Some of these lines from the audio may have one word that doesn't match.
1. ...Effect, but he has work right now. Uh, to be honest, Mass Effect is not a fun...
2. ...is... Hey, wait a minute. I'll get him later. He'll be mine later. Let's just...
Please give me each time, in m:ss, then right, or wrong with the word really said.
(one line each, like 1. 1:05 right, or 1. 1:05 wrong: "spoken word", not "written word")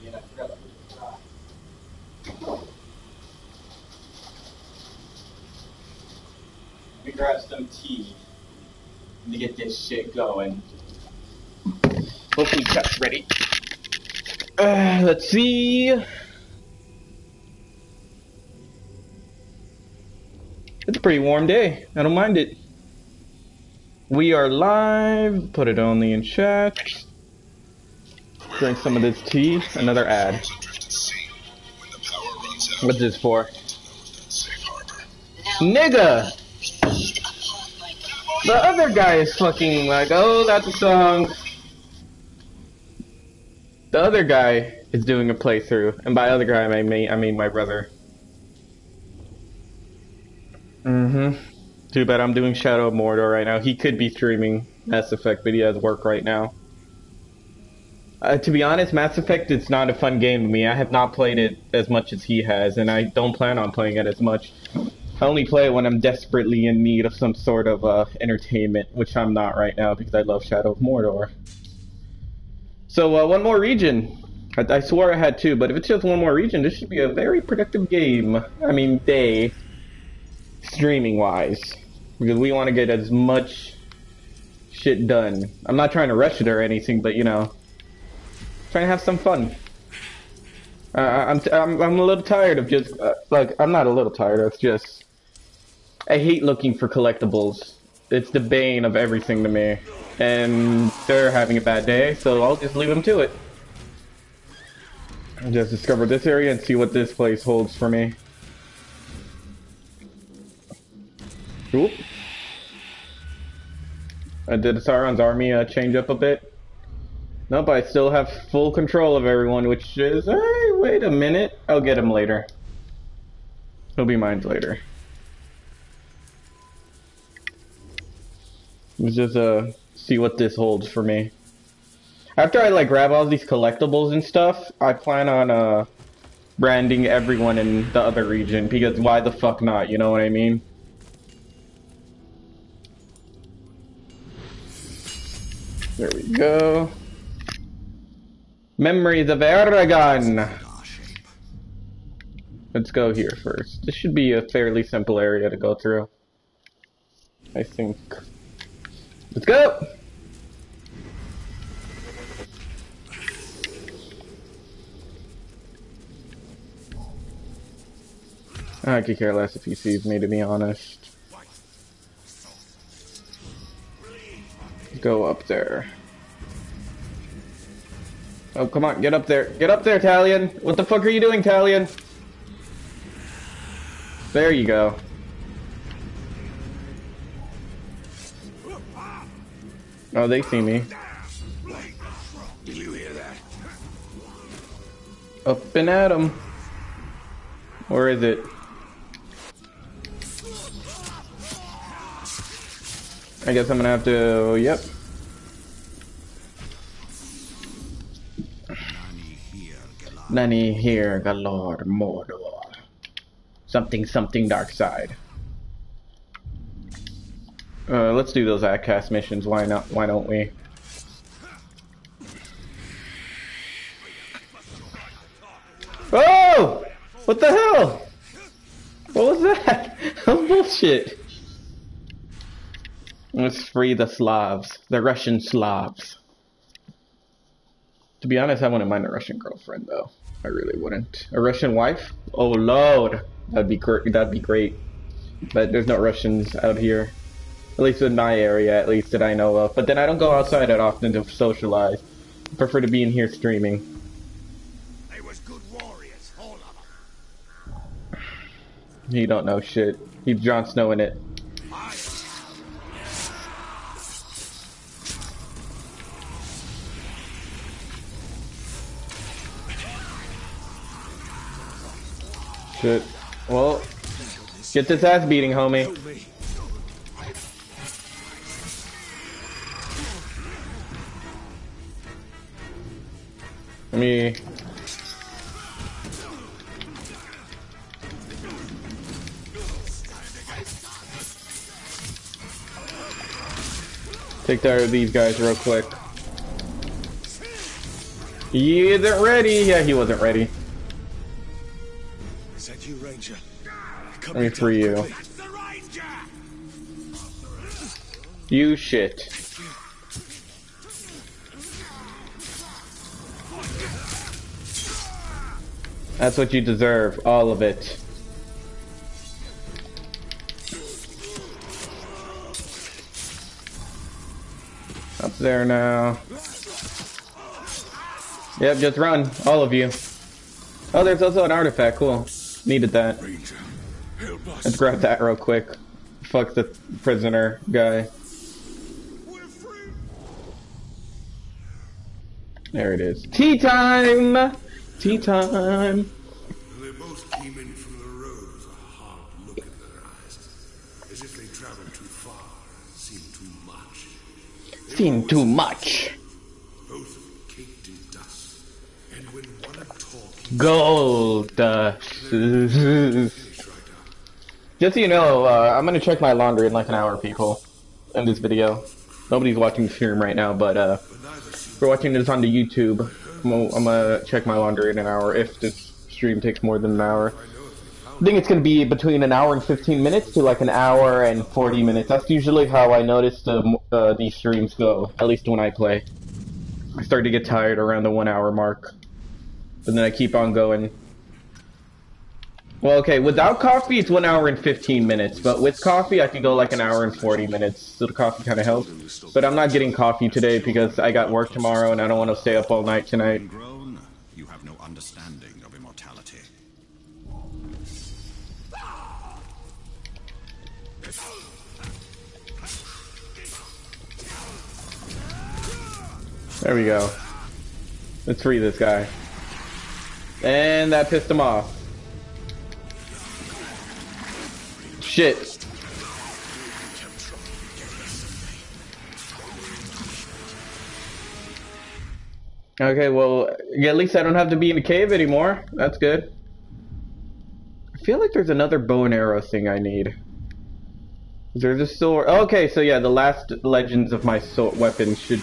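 1. 0:55 right
2. 1:59 right.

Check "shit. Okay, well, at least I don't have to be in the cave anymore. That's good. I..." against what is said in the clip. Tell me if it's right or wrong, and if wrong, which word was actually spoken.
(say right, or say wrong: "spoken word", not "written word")
right.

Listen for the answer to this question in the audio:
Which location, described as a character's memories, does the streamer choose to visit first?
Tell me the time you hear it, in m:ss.
2:28.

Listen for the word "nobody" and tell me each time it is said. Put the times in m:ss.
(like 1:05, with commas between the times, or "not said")
6:09.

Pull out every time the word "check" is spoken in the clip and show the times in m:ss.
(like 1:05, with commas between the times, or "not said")
6:05, 6:14.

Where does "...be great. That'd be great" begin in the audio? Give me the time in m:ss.
4:03.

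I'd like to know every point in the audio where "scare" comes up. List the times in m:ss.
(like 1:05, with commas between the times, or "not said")
not said.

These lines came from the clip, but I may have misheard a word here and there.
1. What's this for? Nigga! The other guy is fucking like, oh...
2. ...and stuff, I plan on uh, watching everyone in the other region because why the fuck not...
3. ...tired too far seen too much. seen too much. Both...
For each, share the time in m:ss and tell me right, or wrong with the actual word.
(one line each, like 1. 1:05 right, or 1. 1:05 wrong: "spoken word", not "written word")
1. 0:32 right
2. 2:14 wrong: "branding", not "watching"
3. 5:51 wrong: "traveled", not "tired".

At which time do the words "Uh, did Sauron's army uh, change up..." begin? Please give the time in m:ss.
1:54.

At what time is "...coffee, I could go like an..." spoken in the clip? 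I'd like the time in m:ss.
6:35.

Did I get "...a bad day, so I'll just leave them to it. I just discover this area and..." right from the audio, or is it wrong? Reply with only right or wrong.
right.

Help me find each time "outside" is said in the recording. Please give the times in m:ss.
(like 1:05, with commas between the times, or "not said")
4:10.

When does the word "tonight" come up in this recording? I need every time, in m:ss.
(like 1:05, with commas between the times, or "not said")
6:43.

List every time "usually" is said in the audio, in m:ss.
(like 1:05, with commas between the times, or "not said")
6:22.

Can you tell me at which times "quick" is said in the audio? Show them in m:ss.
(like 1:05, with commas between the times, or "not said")
4:55, 5:35.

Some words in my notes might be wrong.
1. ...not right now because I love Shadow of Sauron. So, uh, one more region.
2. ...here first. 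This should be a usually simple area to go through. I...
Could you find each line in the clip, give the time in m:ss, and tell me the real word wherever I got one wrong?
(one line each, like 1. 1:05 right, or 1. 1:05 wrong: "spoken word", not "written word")
1. 1:09 wrong: "Mordor", not "Sauron"
2. 2:33 wrong: "fairly", not "usually".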